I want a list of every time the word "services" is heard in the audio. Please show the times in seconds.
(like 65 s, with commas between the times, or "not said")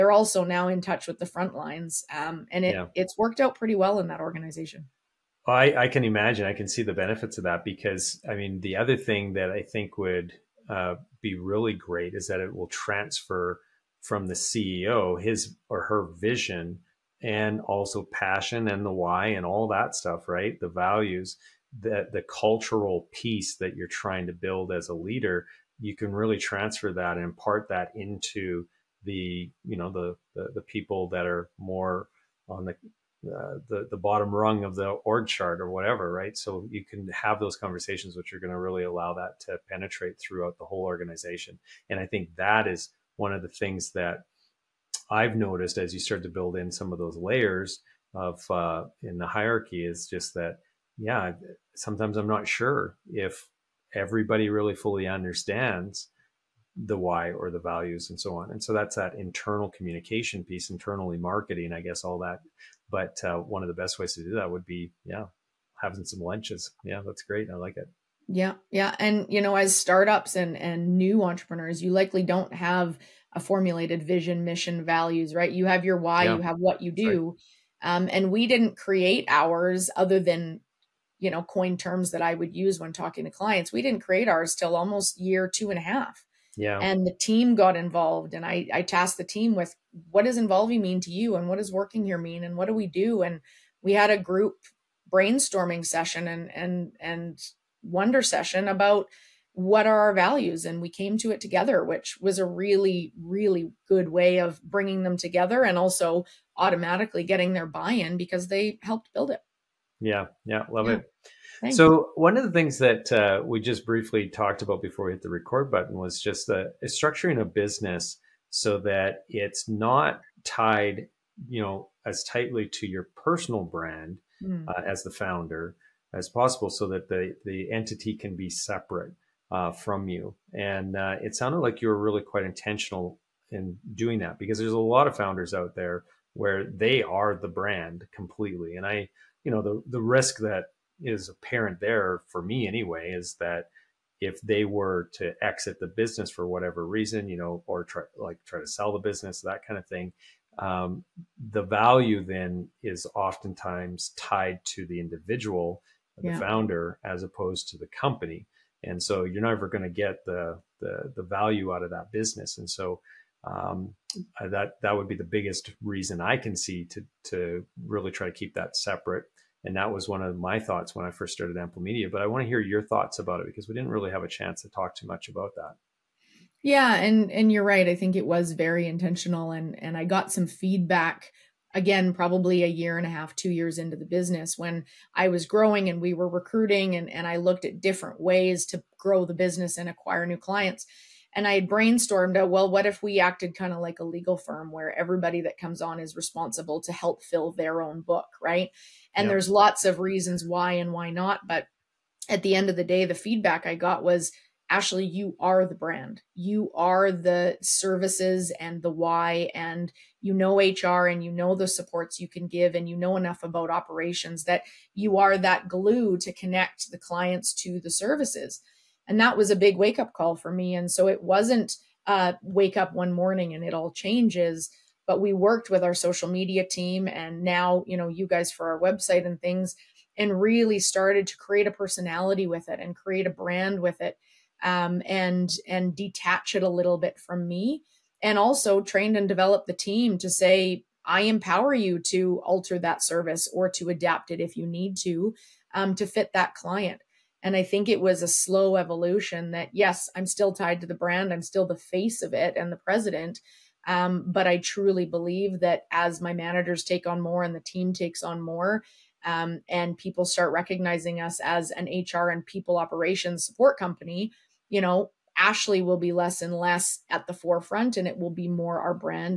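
207 s, 217 s, 243 s.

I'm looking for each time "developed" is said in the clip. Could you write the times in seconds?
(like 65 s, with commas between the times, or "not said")
239 s.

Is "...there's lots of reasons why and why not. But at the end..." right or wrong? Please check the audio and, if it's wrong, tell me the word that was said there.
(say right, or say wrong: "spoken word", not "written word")
right.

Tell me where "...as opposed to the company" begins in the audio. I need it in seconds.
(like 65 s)
157 s.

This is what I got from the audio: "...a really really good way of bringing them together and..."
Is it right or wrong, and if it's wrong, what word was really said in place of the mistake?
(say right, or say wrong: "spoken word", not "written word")
right.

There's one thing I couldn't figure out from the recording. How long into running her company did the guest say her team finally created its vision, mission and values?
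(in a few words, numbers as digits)
2.5 years.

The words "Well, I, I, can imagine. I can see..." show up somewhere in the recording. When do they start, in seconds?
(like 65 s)
5 s.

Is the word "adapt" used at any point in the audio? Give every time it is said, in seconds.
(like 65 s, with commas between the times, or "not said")
243 s.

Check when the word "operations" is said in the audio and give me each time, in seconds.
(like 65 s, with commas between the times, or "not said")
213 s, 262 s.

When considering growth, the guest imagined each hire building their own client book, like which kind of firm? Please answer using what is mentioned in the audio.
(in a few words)
a legal firm.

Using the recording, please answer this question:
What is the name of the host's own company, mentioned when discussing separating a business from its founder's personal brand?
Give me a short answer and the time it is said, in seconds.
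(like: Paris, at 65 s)
Ample Media, at 171 s.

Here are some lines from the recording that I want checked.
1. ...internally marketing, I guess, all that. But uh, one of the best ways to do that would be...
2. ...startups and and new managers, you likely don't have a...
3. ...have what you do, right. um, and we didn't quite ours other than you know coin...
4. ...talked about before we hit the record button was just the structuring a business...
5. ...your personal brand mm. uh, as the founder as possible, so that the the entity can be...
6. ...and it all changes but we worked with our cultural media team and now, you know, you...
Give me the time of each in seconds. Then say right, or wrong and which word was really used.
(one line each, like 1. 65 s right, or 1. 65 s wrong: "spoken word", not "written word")
1. 60 s right
2. 69 s wrong: "entrepreneurs", not "managers"
3. 76 s wrong: "create", not "quite"
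4. 114 s right
5. 122 s right
6. 223 s wrong: "social", not "cultural".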